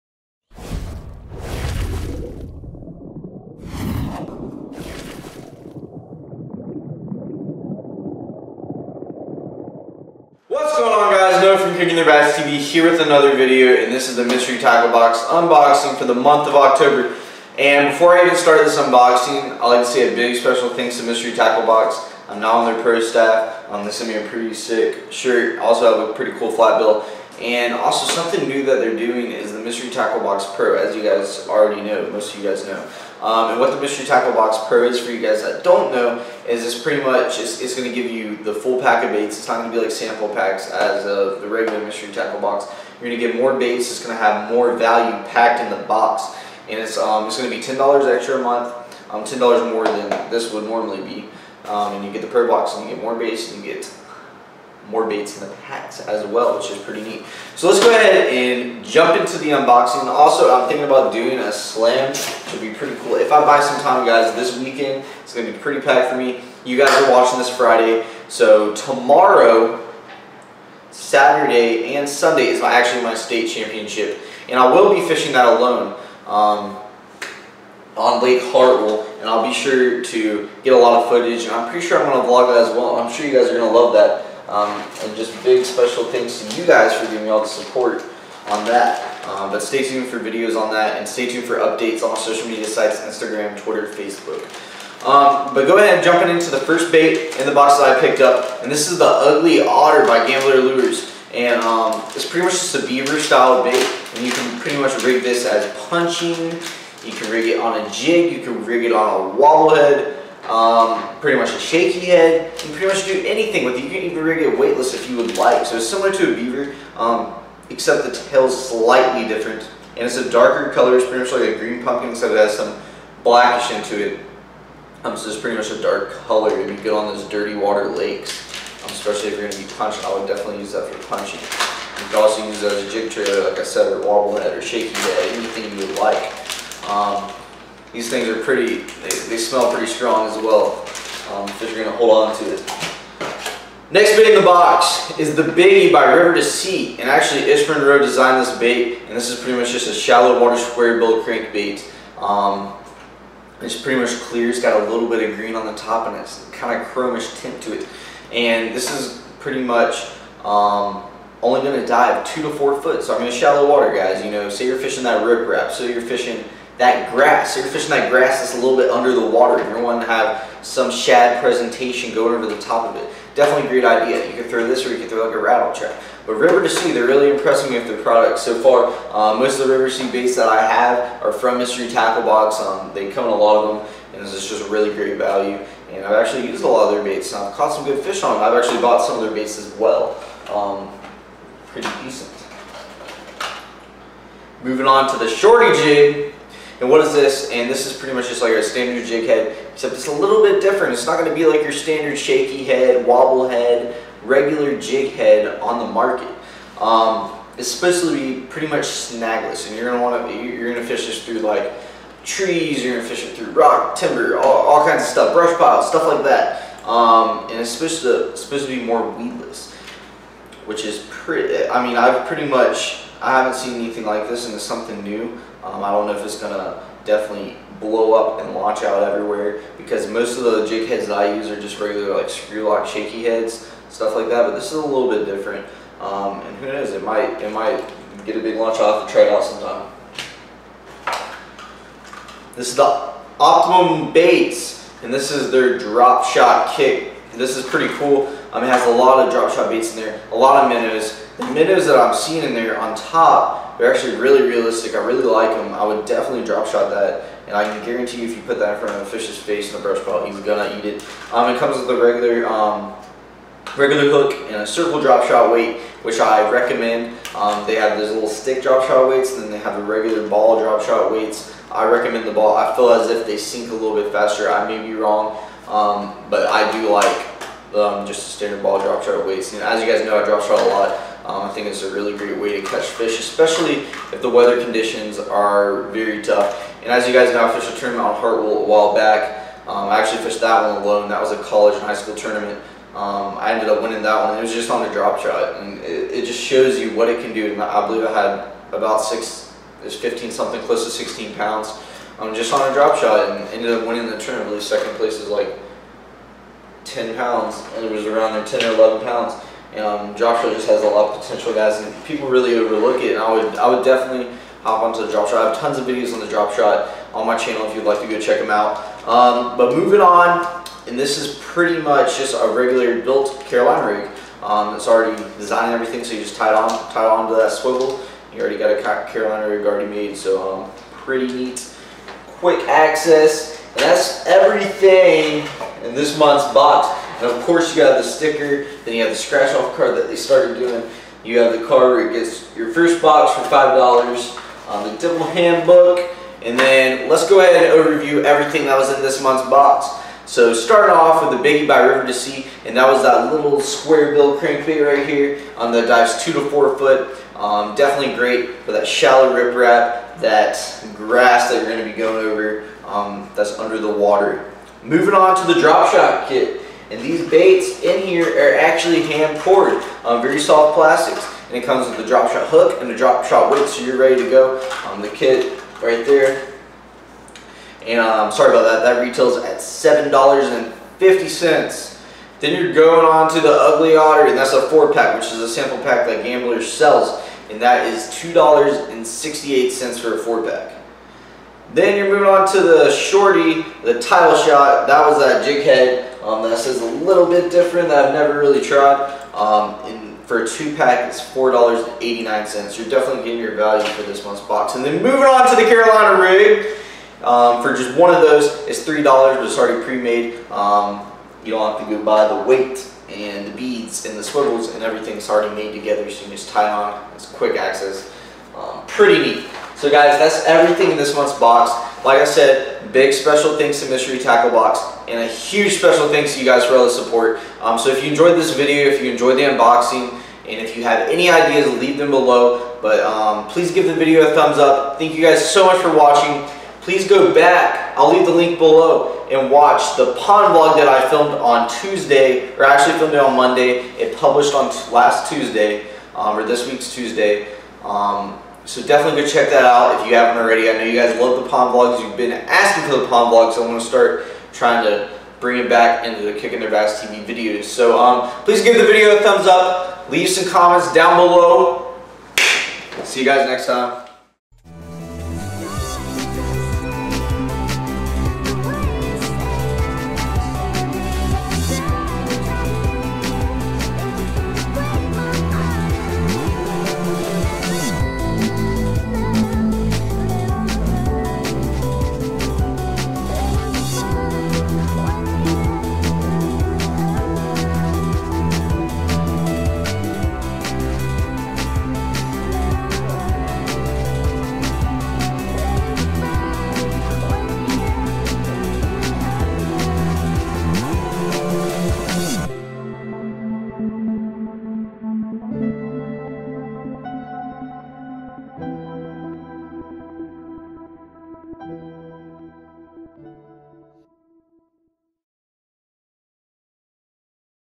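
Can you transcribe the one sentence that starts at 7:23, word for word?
It published on last Tuesday, um, or this week's Tuesday.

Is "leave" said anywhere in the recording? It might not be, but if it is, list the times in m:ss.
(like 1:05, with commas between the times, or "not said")
7:11, 7:18, 7:40.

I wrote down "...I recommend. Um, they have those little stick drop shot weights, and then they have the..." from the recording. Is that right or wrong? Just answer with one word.
right.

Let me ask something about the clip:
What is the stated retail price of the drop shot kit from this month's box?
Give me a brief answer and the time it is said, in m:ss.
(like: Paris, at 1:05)
$7.50, at 6:19.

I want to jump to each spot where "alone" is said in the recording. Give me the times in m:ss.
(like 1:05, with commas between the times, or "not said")
1:15, 4:50.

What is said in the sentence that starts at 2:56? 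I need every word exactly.
But River2Sea, they're really impressing me with their products so far.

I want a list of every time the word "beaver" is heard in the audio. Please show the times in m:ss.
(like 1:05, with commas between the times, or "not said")
1:42, 1:56.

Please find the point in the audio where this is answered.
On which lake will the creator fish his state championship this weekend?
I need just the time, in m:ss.
1:18.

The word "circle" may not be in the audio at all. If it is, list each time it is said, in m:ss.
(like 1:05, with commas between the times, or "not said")
4:24.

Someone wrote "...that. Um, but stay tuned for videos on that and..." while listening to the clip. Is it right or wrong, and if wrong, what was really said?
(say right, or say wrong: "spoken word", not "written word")
right.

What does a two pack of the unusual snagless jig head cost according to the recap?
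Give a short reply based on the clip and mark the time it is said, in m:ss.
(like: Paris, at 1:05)
$4.89, at 6:41.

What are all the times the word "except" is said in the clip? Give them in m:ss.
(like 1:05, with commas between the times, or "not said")
1:57, 2:02, 3:19.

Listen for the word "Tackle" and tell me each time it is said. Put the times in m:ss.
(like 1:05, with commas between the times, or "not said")
0:14, 0:21, 0:29, 0:34, 0:42, 3:01, 7:04.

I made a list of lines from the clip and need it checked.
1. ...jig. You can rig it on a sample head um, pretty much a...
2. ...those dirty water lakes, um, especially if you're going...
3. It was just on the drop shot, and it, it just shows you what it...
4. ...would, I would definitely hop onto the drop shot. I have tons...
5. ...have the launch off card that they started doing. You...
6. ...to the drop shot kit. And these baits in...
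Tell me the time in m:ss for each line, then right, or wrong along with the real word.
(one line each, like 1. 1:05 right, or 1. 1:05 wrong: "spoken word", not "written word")
1. 1:47 wrong: "wobble", not "sample"
2. 2:07 right
3. 4:54 right
4. 5:13 right
5. 5:39 wrong: "scratch", not "launch"
6. 6:05 right.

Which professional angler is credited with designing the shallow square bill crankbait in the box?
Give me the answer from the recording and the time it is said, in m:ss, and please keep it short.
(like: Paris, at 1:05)
Ish Monroe, at 2:27.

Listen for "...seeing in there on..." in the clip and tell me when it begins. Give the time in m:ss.
4:12.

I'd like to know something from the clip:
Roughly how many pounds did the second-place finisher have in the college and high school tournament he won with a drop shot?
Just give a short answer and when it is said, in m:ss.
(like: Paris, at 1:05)
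10, at 5:06.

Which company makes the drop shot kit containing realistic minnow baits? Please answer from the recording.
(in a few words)
Optimum Baits.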